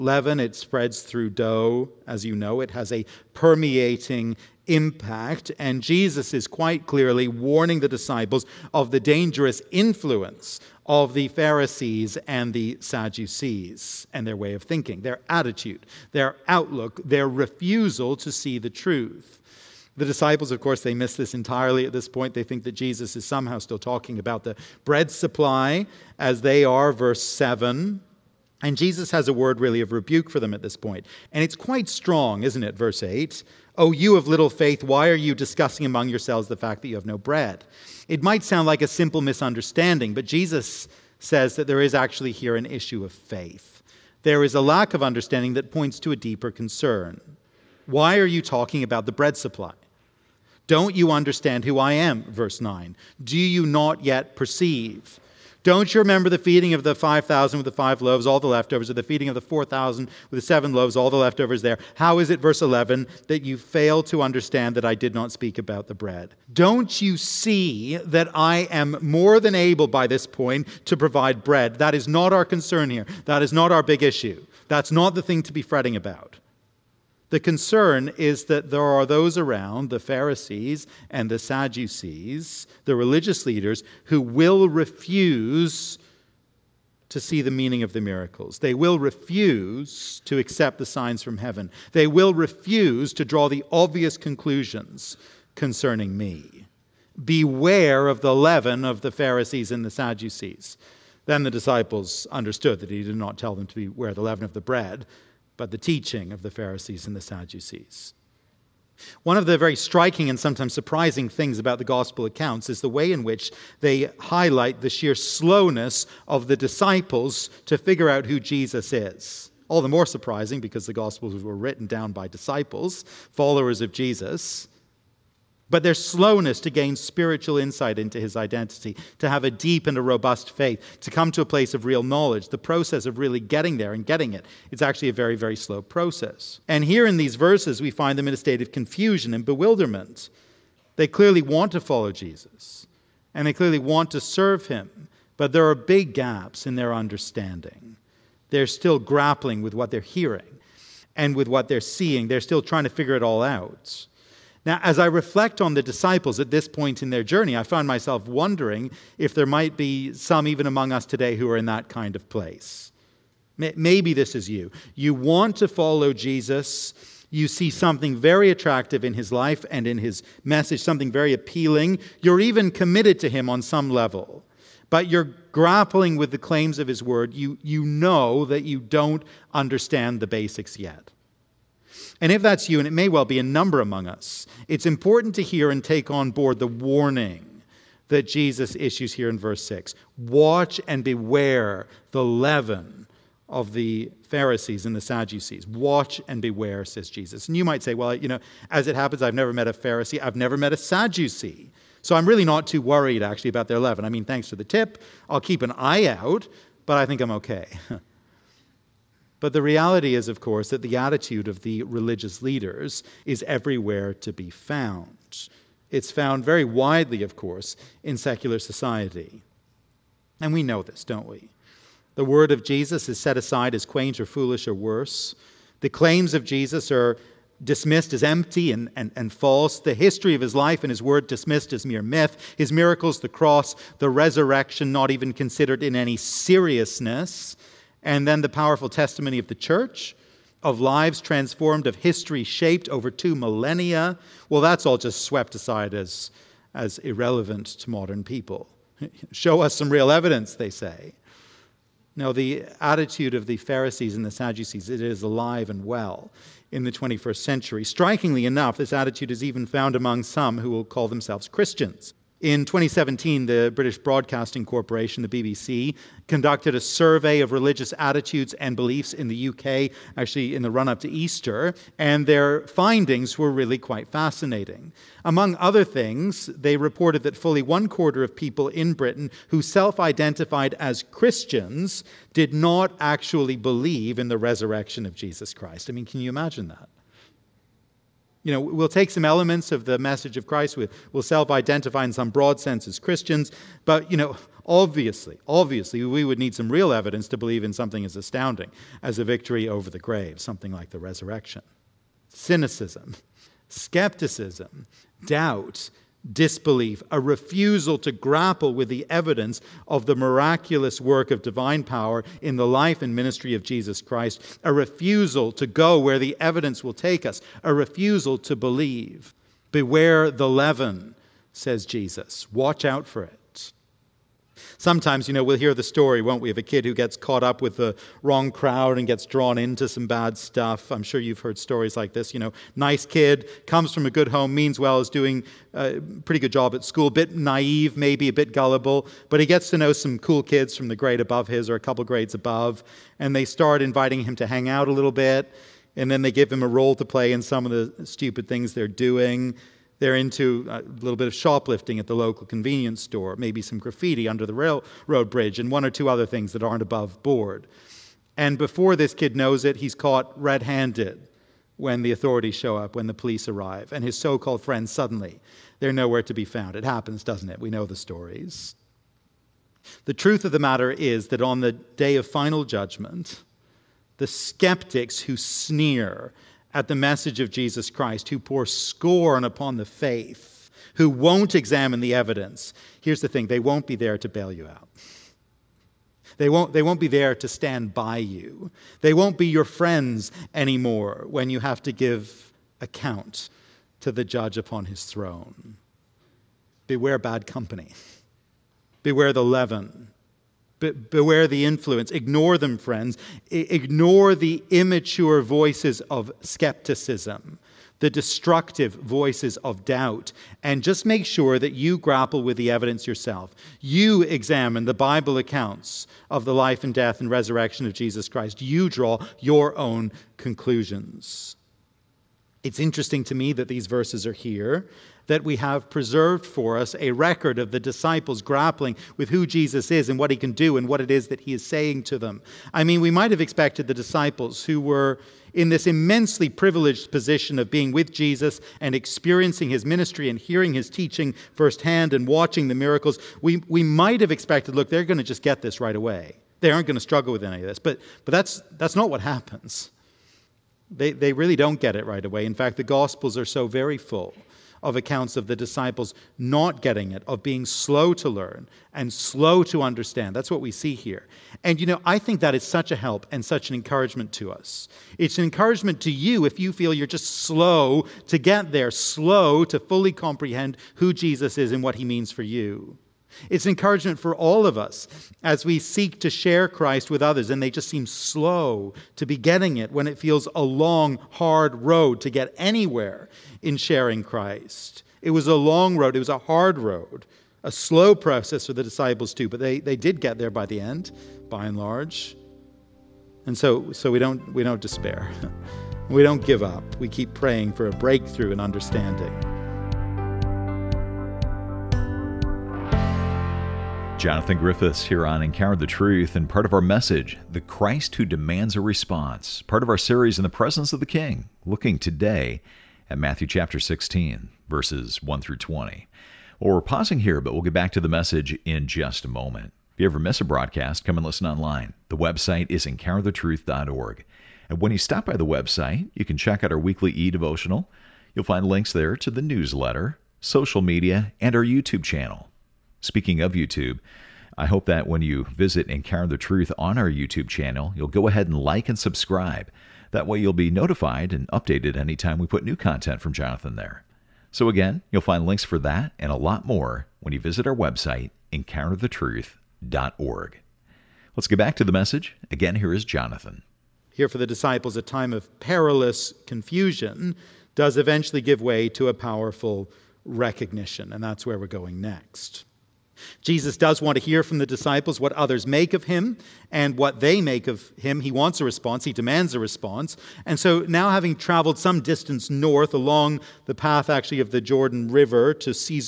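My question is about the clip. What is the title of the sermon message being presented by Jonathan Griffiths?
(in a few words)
The Christ Who Demands a Response.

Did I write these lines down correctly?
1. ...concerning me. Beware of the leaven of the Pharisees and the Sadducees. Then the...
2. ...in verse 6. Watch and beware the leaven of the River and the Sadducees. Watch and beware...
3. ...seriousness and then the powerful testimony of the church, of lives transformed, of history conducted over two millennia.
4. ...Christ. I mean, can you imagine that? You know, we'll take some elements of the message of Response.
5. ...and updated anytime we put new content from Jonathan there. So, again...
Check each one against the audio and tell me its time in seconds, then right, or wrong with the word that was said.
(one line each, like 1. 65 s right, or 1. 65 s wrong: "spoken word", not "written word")
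1. 95 s right
2. 189 s wrong: "Pharisees", not "River"
3. 236 s wrong: "shaped", not "conducted"
4. 285 s wrong: "Christ", not "Response"
5. 541 s right.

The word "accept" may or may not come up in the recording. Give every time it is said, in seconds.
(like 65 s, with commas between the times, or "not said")
90 s.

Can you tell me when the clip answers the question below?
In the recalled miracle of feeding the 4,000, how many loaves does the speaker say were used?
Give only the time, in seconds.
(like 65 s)
60 s.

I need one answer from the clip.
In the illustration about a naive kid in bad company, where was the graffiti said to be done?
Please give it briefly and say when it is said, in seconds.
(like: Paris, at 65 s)
under the railroad bridge, at 354 s.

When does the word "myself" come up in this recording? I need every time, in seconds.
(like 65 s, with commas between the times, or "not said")
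157 s.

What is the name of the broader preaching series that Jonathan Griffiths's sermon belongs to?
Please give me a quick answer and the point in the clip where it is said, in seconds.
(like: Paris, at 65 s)
In the Presence of the King, at 510 s.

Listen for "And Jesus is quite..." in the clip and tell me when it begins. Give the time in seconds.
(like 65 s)
5 s.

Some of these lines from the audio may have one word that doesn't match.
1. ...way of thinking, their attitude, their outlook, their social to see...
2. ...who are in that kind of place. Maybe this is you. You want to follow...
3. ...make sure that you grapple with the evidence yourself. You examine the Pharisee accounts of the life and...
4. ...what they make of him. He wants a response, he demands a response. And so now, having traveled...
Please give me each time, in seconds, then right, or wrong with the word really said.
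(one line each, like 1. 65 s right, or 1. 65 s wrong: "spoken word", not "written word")
1. 14 s wrong: "refusal", not "social"
2. 161 s right
3. 411 s wrong: "Bible", not "Pharisee"
4. 566 s right.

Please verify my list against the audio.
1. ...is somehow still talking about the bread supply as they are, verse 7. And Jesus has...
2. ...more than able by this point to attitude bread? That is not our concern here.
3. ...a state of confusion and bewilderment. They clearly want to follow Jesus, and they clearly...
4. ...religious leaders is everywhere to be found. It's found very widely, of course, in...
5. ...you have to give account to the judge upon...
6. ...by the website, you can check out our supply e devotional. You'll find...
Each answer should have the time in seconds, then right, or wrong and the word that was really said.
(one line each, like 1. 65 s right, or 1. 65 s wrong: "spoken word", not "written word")
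1. 23 s right
2. 69 s wrong: "provide", not "attitude"
3. 138 s right
4. 211 s right
5. 391 s right
6. 525 s wrong: "weekly", not "supply".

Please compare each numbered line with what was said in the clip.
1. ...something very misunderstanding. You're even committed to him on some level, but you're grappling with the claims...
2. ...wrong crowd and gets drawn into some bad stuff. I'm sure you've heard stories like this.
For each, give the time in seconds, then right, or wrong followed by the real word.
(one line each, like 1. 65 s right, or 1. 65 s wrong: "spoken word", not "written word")
1. 170 s wrong: "appealing", not "misunderstanding"
2. 328 s right.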